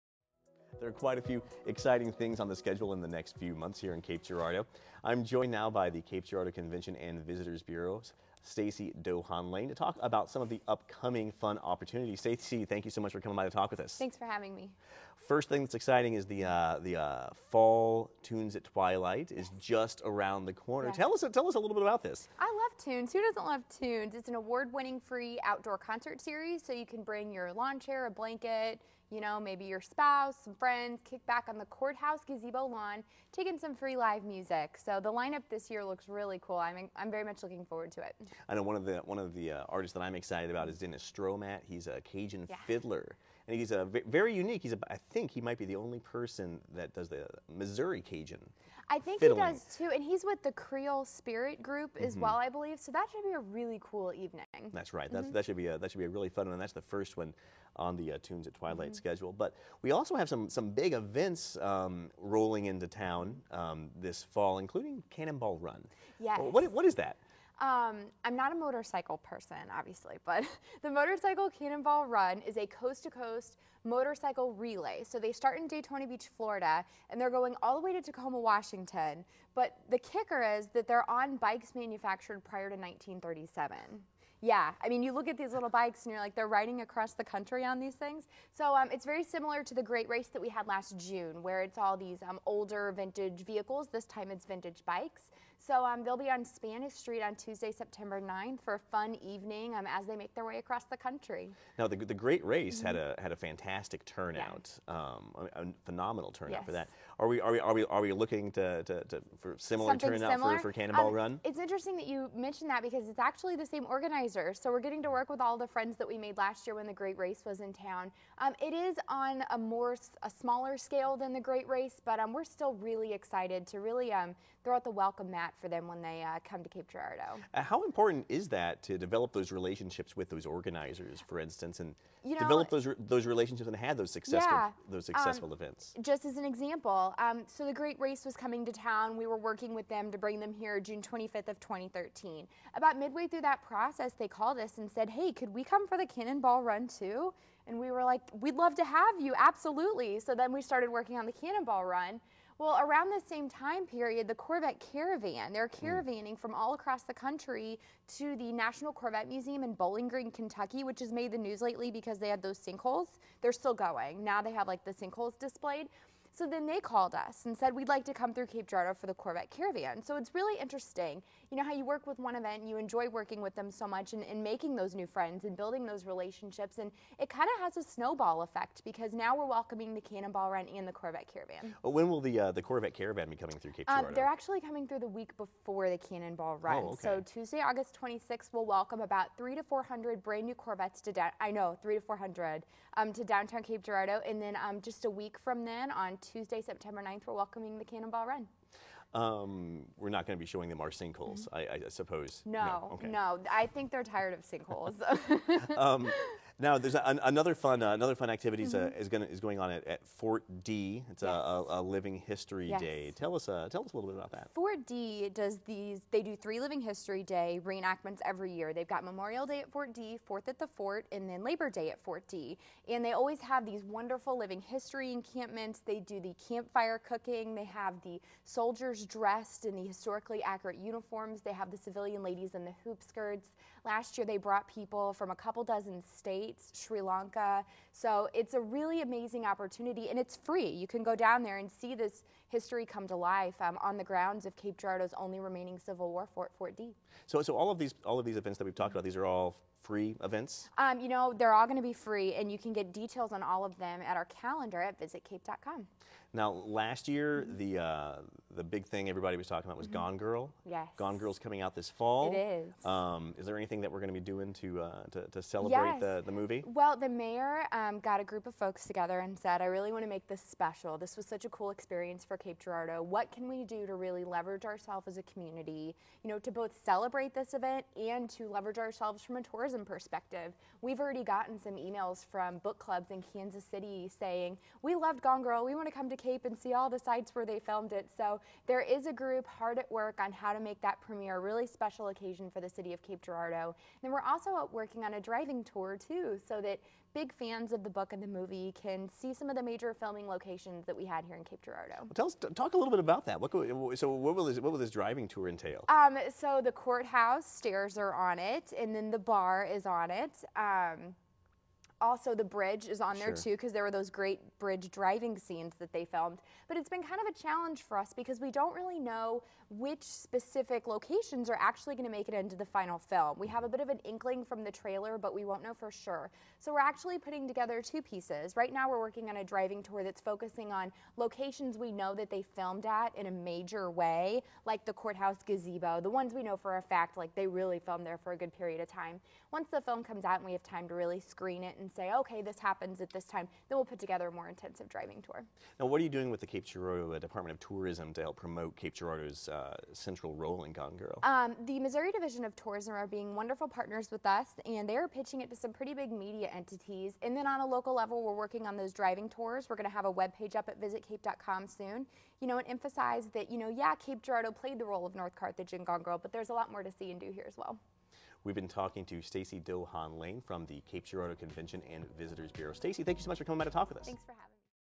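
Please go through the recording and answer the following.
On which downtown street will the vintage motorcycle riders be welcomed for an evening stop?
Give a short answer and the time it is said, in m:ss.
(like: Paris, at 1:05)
Spanish Street, at 1:36.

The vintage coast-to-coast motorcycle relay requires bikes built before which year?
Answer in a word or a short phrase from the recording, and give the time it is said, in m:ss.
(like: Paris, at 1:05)
1937, at 1:22.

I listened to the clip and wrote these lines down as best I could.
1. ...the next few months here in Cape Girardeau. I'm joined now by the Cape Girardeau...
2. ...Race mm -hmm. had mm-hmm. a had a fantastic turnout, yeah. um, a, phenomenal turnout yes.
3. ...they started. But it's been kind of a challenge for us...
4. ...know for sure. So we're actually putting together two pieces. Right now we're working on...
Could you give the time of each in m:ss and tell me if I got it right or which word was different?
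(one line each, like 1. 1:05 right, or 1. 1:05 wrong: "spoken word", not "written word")
1. 0:03 right
2. 1:42 right
3. 5:15 wrong: "filmed", not "started"
4. 5:25 right.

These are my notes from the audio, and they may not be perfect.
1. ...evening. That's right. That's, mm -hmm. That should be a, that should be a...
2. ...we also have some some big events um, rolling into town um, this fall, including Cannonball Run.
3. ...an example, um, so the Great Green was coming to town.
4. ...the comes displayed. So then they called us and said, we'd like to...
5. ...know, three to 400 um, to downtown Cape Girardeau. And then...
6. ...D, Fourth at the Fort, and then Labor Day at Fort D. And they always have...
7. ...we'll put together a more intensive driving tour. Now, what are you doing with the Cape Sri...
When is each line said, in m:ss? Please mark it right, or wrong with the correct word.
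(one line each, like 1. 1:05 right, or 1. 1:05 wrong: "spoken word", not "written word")
1. 0:54 right
2. 0:59 right
3. 2:16 wrong: "Race", not "Green"
4. 2:44 wrong: "sinkholes", not "comes"
5. 3:11 right
6. 3:39 right
7. 5:43 wrong: "Girardeau", not "Sri".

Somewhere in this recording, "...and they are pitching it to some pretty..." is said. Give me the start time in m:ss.
5:54.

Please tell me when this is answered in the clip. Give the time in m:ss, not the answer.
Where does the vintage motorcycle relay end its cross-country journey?
1:18.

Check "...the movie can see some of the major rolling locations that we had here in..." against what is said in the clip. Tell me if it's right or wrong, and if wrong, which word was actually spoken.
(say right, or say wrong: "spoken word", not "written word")
wrong: "filming", not "rolling".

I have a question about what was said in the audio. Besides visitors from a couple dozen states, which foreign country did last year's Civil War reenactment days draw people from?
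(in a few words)
Sri Lanka.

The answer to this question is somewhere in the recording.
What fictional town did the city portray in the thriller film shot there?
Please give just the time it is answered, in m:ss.
6:05.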